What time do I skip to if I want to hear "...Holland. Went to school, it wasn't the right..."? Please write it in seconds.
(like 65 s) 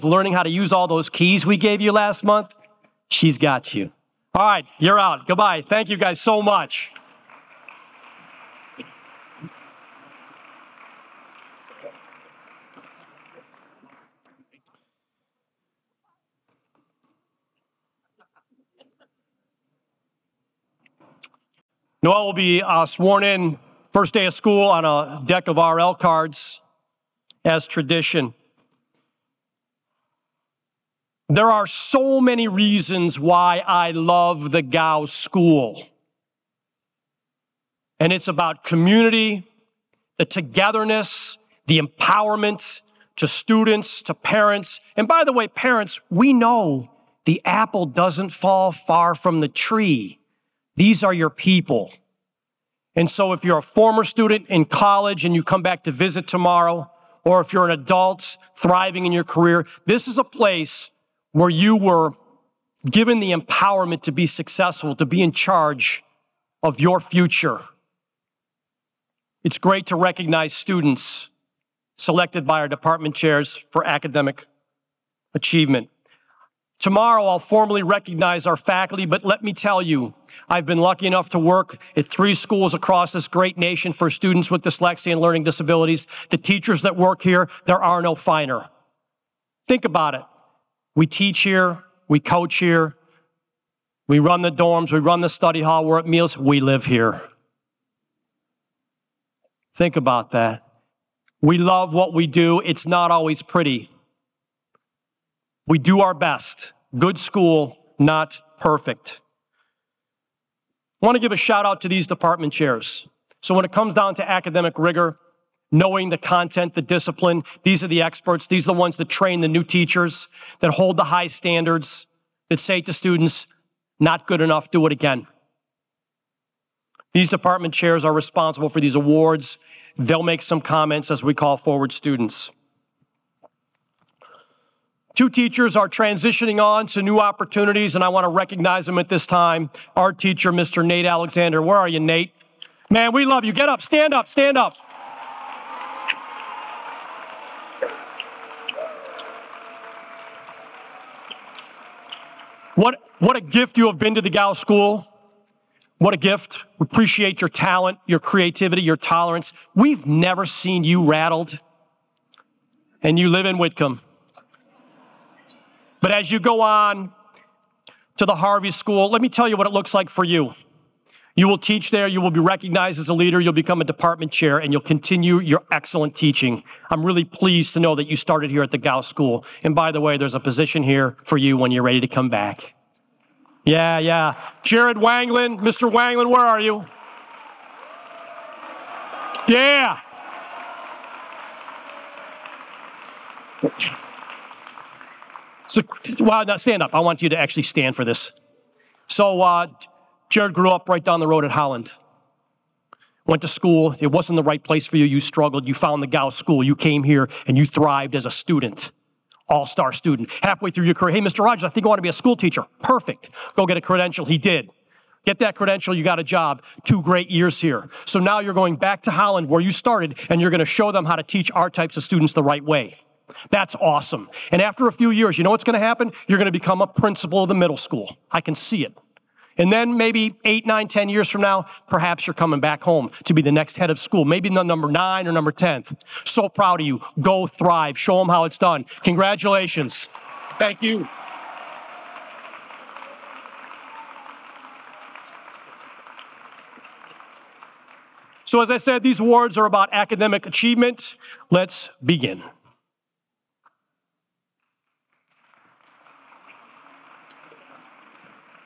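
201 s.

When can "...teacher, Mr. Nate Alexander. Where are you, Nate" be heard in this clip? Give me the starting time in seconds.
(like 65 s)
140 s.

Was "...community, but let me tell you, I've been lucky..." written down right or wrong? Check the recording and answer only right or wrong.
wrong.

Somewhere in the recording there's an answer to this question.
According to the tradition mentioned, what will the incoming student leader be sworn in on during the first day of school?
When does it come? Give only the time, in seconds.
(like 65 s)
25 s.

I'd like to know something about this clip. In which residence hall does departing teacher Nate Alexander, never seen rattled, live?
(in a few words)
Whitcomb.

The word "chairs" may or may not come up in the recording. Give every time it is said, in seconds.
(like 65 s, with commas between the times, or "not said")
73 s, 112 s, 127 s, 174 s.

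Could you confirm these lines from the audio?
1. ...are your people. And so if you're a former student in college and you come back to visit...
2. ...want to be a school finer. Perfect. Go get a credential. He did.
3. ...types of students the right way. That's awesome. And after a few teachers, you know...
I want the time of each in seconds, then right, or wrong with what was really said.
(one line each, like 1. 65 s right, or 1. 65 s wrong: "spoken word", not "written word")
1. 51 s right
2. 211 s wrong: "teacher", not "finer"
3. 221 s wrong: "years", not "teachers".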